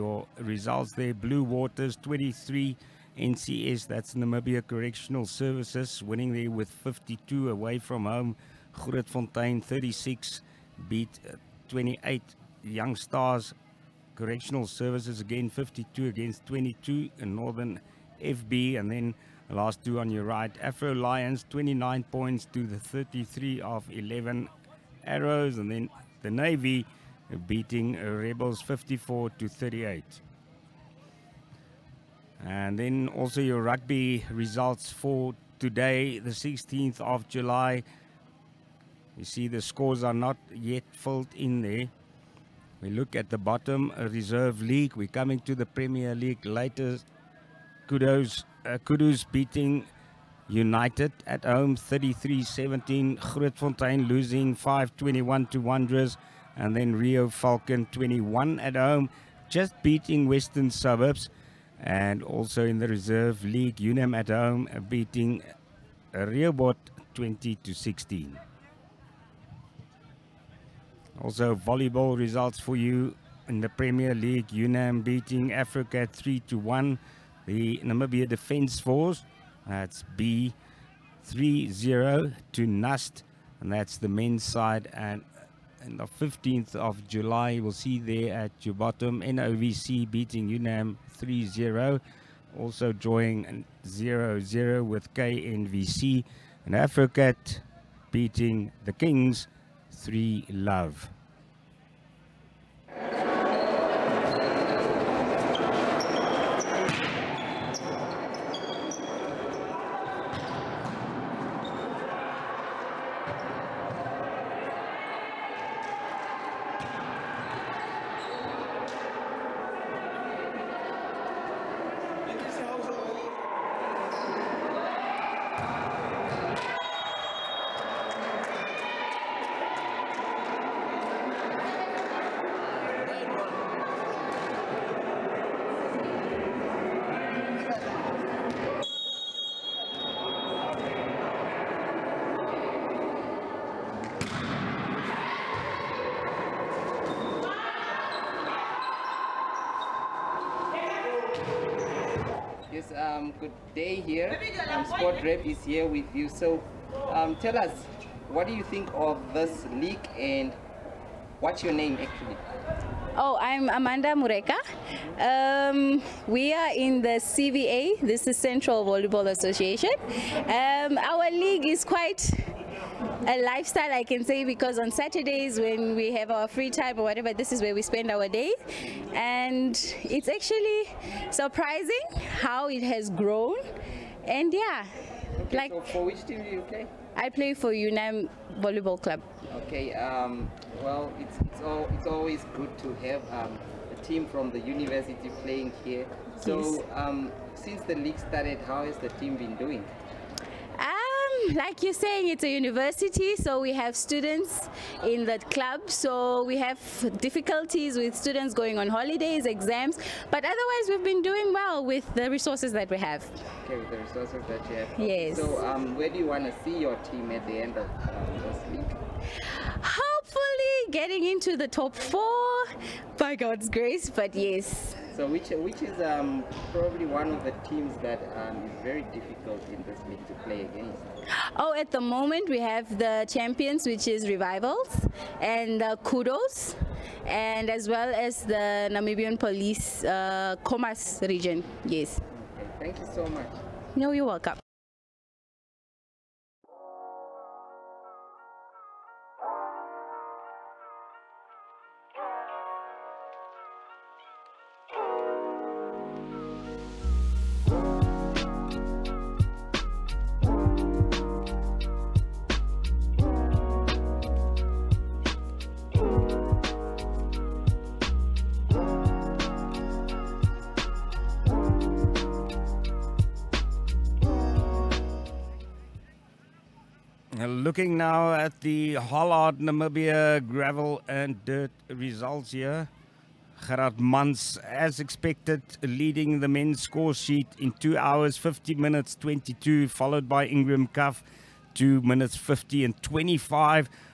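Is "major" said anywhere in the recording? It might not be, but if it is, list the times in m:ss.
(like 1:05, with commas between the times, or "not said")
not said.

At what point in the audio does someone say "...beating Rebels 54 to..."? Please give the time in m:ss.
0:27.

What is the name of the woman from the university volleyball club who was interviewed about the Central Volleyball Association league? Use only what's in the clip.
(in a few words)
Amanda Mureka.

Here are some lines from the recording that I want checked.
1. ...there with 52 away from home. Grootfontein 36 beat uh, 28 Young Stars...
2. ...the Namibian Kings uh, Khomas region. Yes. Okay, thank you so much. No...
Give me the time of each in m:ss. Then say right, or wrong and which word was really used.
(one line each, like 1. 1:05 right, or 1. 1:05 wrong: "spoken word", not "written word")
1. 0:06 right
2. 3:58 wrong: "Police", not "Kings".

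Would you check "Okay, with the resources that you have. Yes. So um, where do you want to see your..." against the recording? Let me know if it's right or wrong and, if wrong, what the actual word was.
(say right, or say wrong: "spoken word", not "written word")
right.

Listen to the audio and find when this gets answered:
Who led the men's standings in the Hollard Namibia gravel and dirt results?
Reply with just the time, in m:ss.
4:43.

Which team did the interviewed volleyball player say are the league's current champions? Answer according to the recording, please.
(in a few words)
Revivals.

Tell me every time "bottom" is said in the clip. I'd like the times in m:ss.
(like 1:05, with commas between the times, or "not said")
0:43, 1:28.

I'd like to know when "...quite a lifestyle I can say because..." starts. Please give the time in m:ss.
2:51.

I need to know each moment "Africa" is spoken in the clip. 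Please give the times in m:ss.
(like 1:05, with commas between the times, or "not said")
1:15, 1:36.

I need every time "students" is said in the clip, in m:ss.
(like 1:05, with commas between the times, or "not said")
3:23, 3:28.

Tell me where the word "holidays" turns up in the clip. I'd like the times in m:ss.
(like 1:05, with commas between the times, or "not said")
3:28.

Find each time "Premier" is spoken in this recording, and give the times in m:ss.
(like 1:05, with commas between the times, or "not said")
0:45, 1:13.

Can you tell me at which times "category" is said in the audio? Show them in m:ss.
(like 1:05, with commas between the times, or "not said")
not said.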